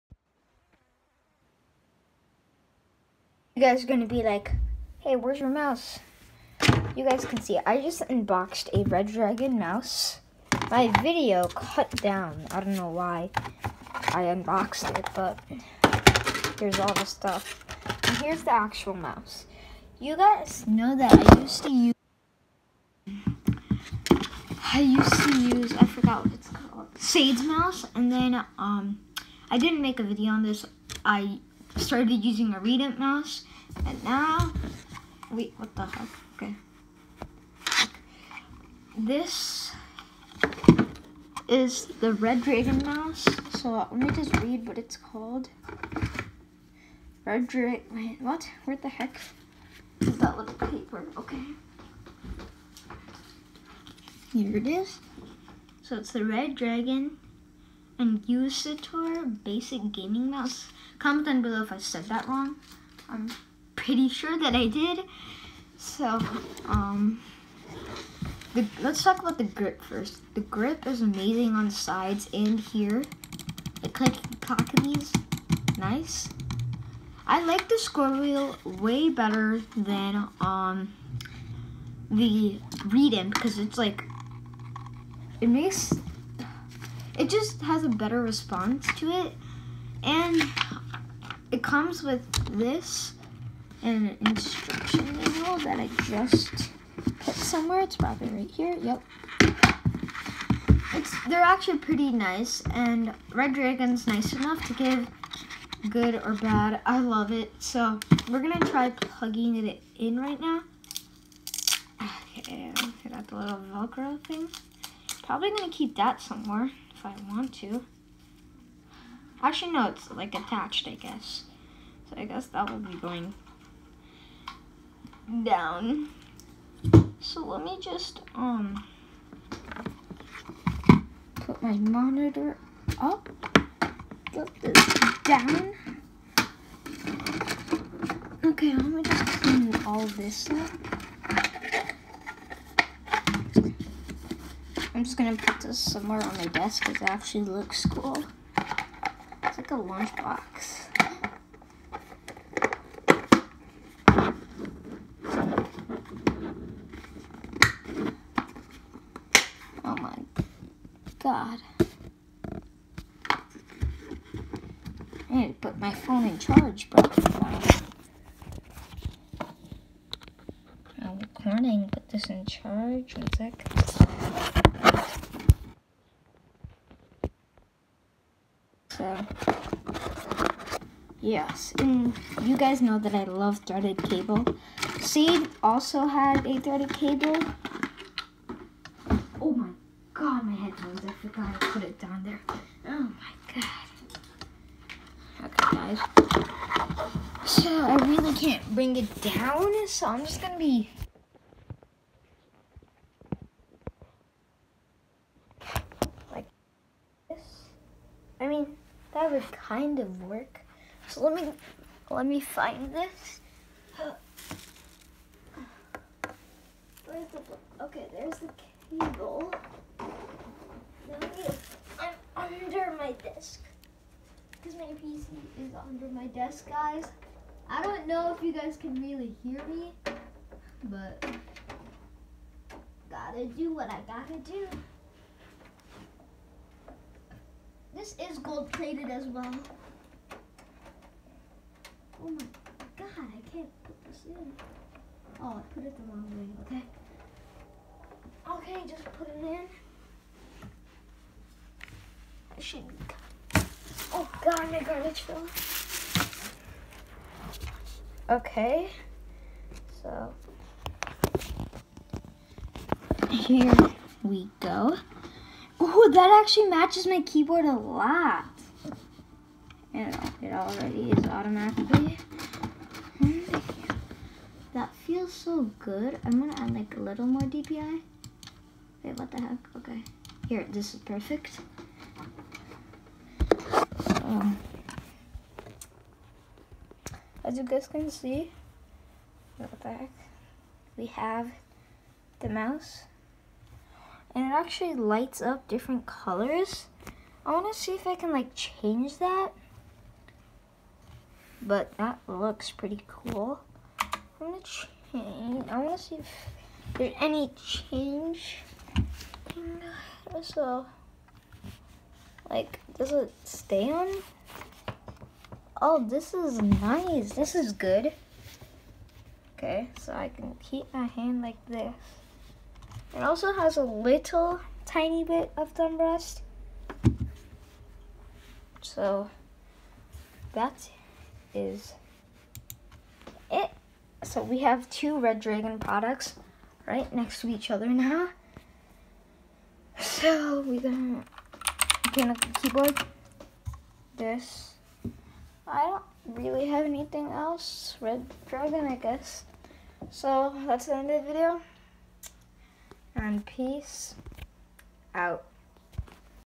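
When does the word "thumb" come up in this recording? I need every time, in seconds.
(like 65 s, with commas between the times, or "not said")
325 s.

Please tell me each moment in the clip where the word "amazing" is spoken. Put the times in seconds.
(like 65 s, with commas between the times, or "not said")
71 s.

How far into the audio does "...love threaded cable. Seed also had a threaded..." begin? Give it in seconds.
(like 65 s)
183 s.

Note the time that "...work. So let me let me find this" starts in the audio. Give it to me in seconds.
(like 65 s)
210 s.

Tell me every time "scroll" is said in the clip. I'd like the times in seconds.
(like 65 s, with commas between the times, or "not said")
77 s.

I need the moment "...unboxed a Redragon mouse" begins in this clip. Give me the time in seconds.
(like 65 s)
8 s.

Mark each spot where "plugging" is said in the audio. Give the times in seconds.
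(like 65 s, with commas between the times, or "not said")
108 s.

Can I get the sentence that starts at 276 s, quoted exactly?
I'm gonna add like a little more DPI.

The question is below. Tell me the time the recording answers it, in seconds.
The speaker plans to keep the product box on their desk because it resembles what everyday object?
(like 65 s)
149 s.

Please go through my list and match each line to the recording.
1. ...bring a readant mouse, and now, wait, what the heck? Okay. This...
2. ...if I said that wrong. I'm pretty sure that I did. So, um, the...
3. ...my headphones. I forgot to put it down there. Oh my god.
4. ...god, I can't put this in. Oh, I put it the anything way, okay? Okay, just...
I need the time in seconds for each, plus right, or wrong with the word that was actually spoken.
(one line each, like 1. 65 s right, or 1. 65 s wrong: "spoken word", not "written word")
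1. 32 s wrong: "using", not "bring"
2. 61 s right
3. 190 s right
4. 242 s wrong: "wrong", not "anything".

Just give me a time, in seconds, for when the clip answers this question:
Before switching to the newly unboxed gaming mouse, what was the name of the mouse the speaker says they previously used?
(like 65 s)
26 s.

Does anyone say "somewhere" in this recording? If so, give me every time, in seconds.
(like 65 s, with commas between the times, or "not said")
97 s, 116 s, 145 s.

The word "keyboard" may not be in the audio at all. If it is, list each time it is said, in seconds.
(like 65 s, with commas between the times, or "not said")
267 s, 342 s.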